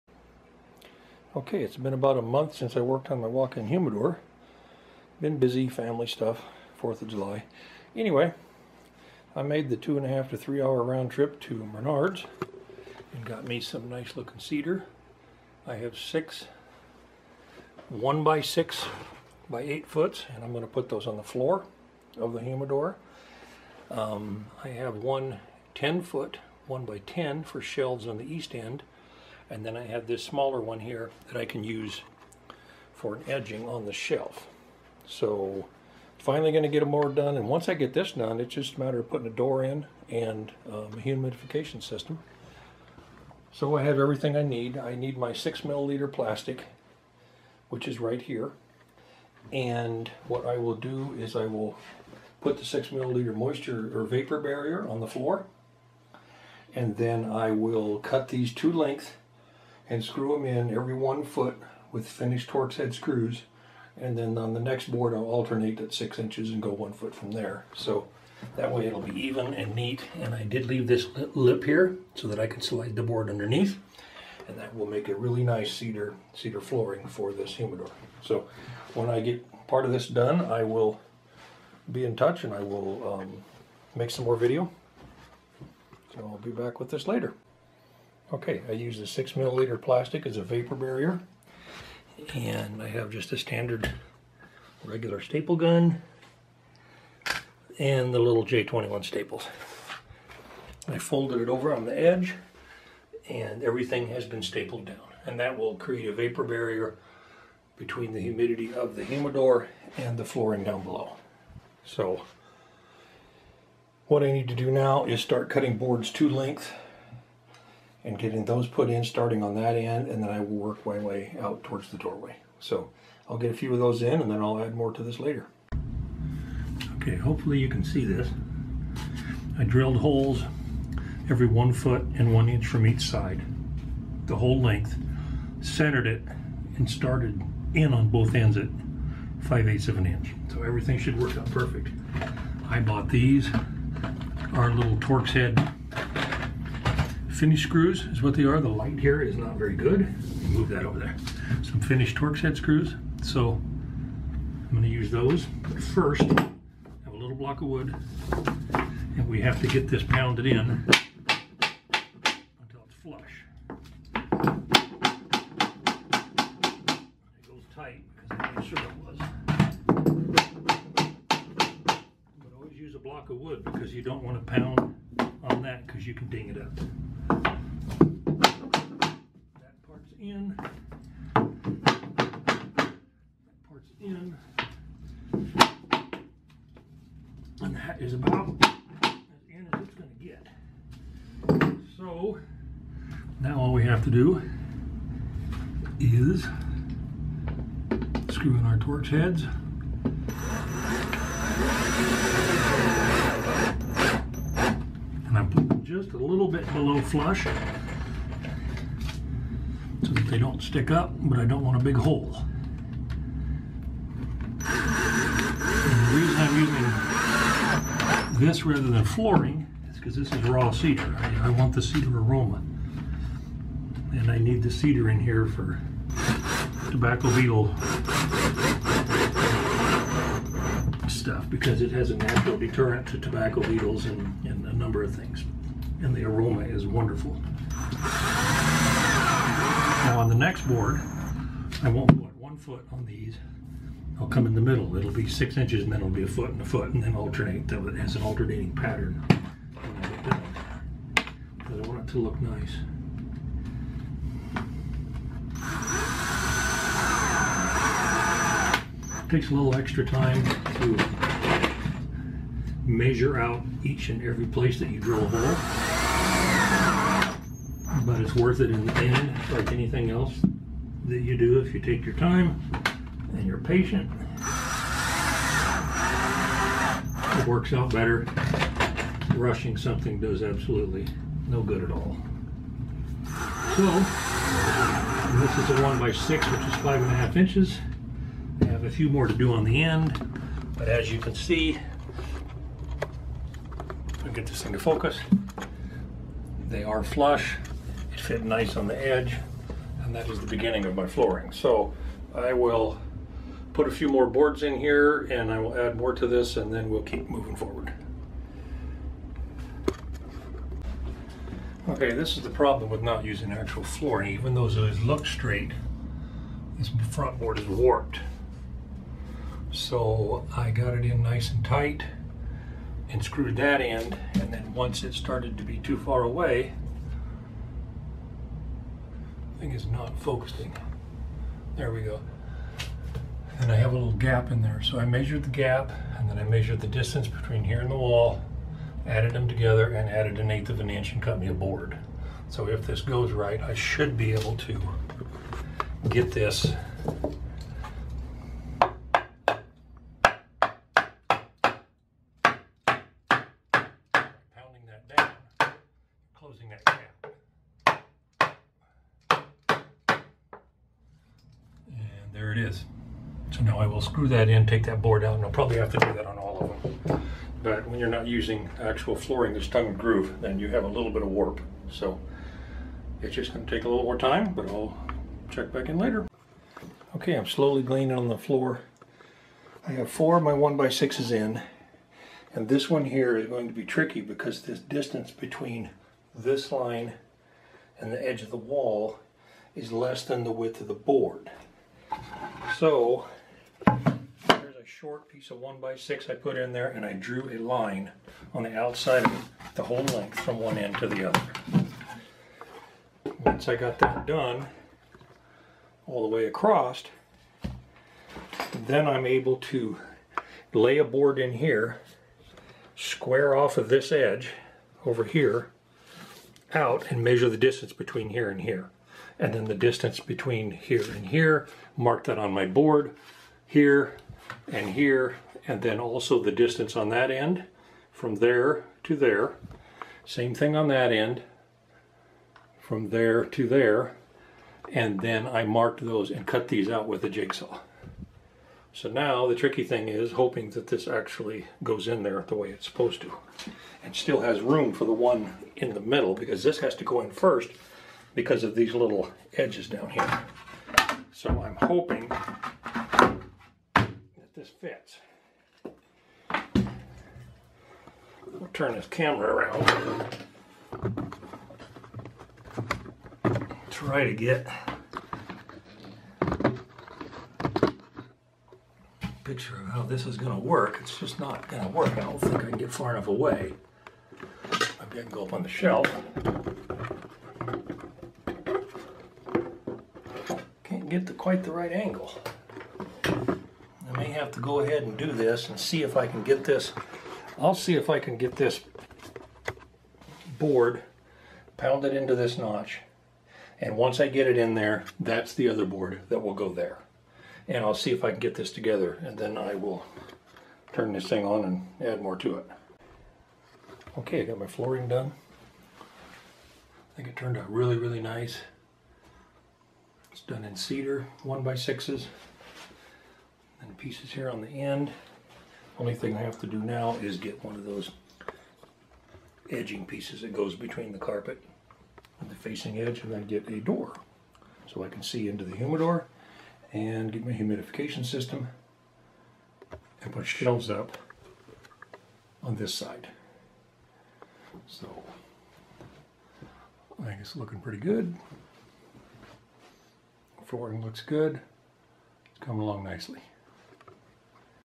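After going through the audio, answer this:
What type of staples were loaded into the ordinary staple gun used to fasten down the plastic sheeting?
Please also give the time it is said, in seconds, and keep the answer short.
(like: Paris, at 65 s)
J21, at 98 s.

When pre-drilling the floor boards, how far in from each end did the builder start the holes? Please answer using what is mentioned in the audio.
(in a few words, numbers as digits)
5/8 of an inch.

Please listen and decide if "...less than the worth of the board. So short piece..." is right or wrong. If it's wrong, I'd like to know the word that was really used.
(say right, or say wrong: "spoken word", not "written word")
wrong: "width", not "worth".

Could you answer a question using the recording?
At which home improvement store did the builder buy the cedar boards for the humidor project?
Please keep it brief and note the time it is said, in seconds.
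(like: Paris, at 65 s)
Menards, at 11 s.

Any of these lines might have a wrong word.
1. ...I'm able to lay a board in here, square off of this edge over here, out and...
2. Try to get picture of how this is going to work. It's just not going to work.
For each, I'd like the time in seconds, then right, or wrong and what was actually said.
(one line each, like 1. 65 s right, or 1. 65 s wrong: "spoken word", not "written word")
1. 409 s right
2. 463 s right.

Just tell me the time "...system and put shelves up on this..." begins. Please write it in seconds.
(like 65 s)
528 s.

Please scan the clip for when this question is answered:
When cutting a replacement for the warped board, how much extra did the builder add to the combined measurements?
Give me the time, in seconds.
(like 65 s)
340 s.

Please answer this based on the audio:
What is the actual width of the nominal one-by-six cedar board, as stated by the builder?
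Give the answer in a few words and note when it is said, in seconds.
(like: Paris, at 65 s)
5.5 inches, at 286 s.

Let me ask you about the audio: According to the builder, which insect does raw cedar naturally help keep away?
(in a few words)
tobacco beetles.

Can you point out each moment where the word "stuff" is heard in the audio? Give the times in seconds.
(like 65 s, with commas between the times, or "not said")
6 s, 231 s.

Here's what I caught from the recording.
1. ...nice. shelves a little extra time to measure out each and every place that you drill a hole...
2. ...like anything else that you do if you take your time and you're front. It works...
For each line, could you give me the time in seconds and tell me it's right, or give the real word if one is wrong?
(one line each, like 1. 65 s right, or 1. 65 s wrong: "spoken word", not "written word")
1. 252 s wrong: "takes", not "shelves"
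2. 269 s wrong: "patient", not "front".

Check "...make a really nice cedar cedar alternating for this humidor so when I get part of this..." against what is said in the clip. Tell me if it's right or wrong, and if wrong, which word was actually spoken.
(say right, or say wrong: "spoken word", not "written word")
wrong: "flooring", not "alternating".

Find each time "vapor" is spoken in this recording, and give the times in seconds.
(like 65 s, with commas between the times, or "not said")
54 s, 90 s, 106 s.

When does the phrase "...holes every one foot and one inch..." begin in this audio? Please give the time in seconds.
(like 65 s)
129 s.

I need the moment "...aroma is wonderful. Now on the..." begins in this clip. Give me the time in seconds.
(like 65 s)
236 s.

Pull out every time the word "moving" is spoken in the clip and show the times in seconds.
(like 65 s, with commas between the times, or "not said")
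307 s.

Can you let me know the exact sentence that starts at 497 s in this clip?
And I'll see if I can get this together and then I will turn this thing on and add more to it.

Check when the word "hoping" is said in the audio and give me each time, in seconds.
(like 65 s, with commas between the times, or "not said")
440 s, 451 s.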